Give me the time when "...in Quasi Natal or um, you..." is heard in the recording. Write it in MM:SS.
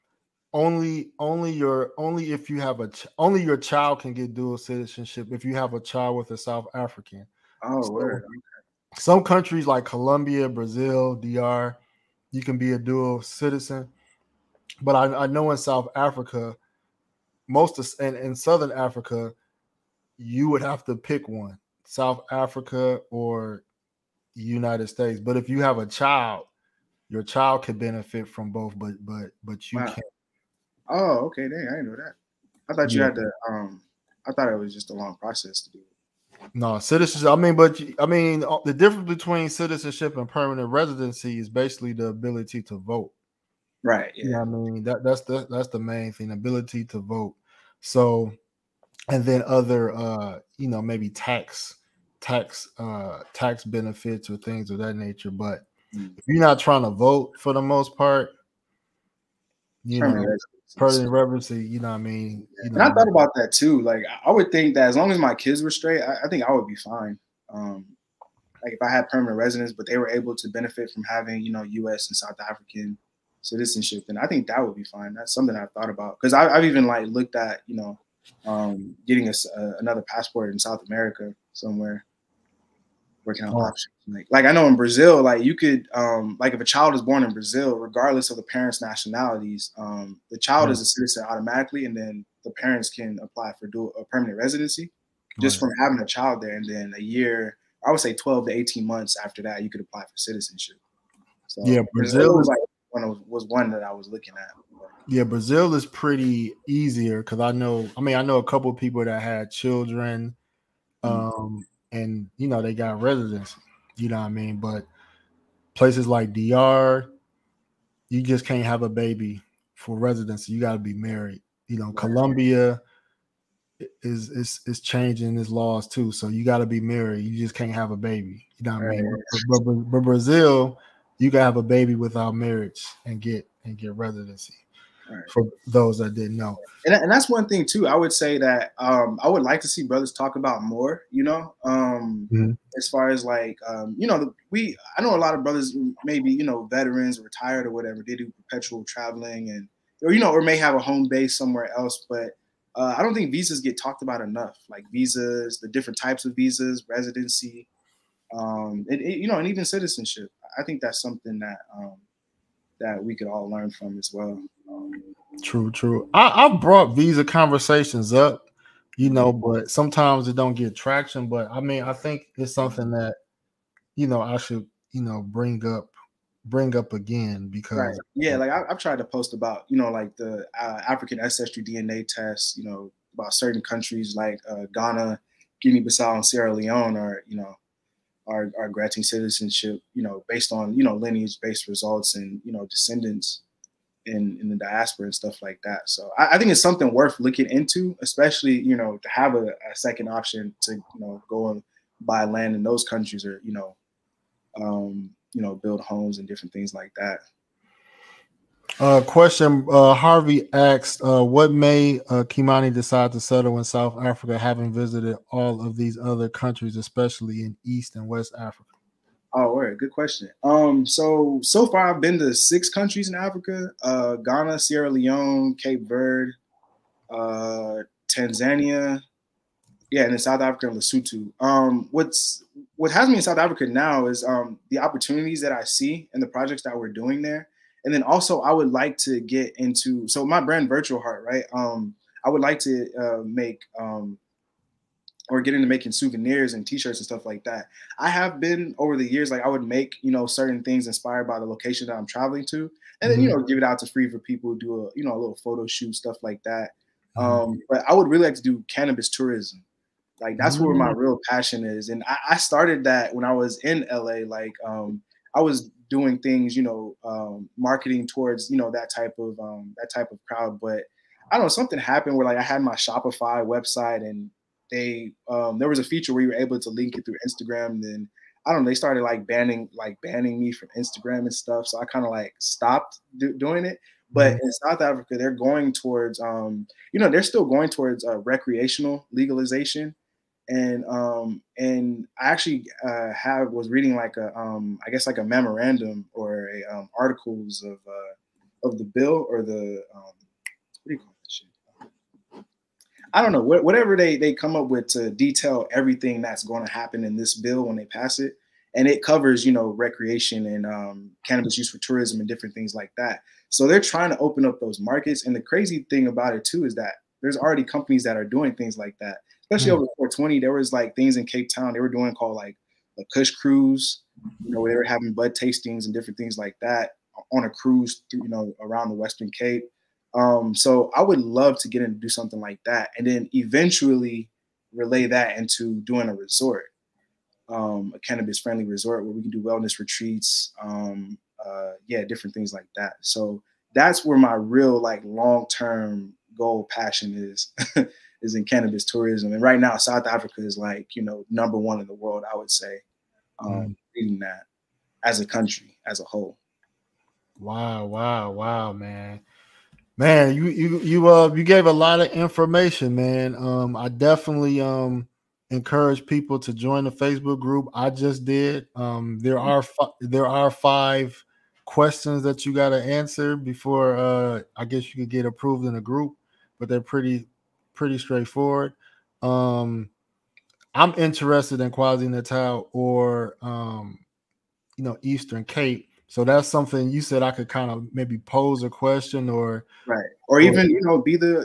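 06:21.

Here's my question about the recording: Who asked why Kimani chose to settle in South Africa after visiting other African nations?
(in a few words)
Harvey.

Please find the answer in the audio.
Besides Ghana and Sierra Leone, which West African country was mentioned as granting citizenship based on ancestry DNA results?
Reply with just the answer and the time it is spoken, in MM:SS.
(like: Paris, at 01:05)
Guinea-Bissau, at 03:05.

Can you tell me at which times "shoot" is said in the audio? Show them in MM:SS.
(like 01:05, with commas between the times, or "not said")
04:15.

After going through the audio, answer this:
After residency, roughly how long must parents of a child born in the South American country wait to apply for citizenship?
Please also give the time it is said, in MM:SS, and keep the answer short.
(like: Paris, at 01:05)
12 to 18 months, at 01:38.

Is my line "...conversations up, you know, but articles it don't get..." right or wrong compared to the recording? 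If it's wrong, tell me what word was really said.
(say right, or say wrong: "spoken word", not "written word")
wrong: "sometimes", not "articles".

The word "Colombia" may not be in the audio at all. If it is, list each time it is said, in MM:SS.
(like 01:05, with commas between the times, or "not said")
00:09, 02:01.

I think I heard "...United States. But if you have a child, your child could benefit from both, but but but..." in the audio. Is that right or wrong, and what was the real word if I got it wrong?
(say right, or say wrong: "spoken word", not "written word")
right.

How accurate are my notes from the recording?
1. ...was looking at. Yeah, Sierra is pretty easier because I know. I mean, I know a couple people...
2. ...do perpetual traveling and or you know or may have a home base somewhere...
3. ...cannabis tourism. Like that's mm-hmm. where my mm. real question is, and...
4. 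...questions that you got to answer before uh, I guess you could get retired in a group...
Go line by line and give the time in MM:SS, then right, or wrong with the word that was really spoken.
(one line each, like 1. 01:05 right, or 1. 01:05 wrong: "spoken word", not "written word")
1. 01:43 wrong: "Brazil", not "Sierra"
2. 02:28 right
3. 04:18 wrong: "passion", not "question"
4. 06:11 wrong: "approved", not "retired".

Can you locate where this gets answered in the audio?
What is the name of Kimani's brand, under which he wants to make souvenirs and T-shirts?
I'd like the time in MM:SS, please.
04:00.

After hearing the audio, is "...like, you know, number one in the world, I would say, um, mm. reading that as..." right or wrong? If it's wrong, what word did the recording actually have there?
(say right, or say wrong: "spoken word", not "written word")
right.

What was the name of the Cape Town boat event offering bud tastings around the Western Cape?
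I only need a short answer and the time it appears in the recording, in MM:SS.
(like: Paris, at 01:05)
Kush cruise, at 05:23.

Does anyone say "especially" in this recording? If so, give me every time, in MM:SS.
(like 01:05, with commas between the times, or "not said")
03:18, 03:36, 05:19.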